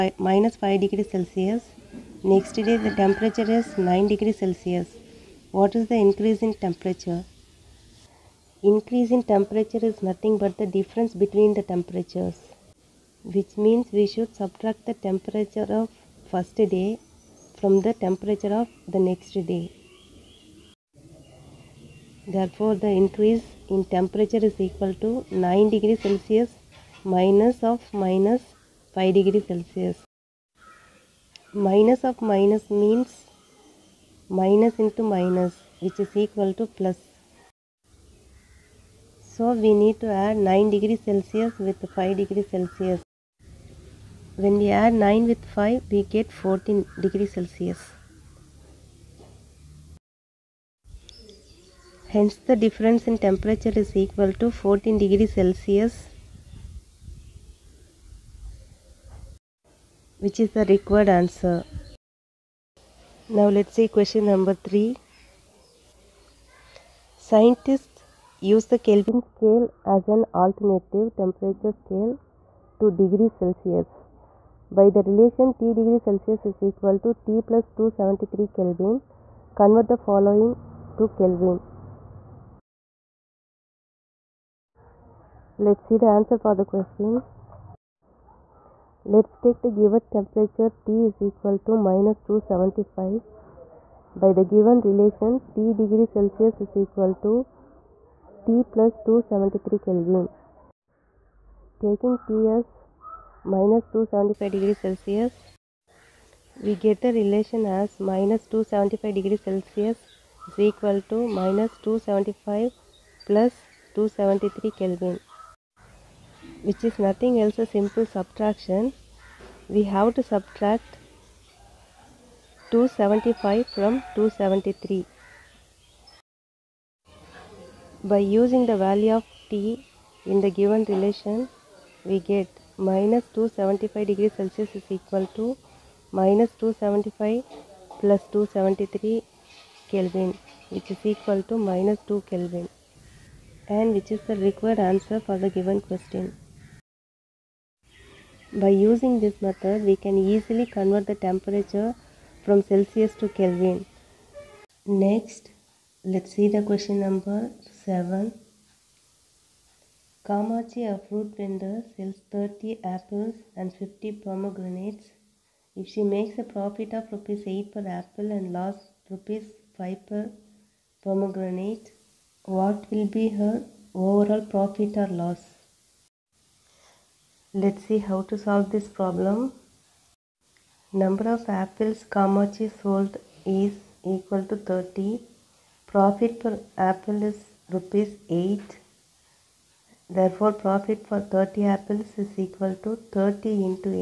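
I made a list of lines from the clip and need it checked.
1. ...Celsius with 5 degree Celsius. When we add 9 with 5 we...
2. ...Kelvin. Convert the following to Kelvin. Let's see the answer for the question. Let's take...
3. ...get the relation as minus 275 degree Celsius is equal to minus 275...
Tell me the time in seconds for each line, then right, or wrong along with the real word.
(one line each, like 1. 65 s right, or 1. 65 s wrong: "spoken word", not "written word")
1. 41 s right
2. 78 s right
3. 106 s right.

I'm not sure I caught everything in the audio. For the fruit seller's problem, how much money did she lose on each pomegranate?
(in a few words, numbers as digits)
5 rupees.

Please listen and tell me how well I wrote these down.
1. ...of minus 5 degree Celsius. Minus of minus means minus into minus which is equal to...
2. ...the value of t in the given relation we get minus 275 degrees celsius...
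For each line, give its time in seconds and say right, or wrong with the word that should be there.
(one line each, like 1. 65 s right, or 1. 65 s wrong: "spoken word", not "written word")
1. 27 s right
2. 128 s right.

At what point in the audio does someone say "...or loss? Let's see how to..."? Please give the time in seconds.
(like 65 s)
174 s.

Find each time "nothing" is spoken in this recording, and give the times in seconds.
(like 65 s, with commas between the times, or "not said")
10 s, 116 s.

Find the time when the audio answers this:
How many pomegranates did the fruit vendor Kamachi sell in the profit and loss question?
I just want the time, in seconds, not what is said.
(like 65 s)
163 s.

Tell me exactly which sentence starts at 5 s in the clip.
What is the increase in temperature?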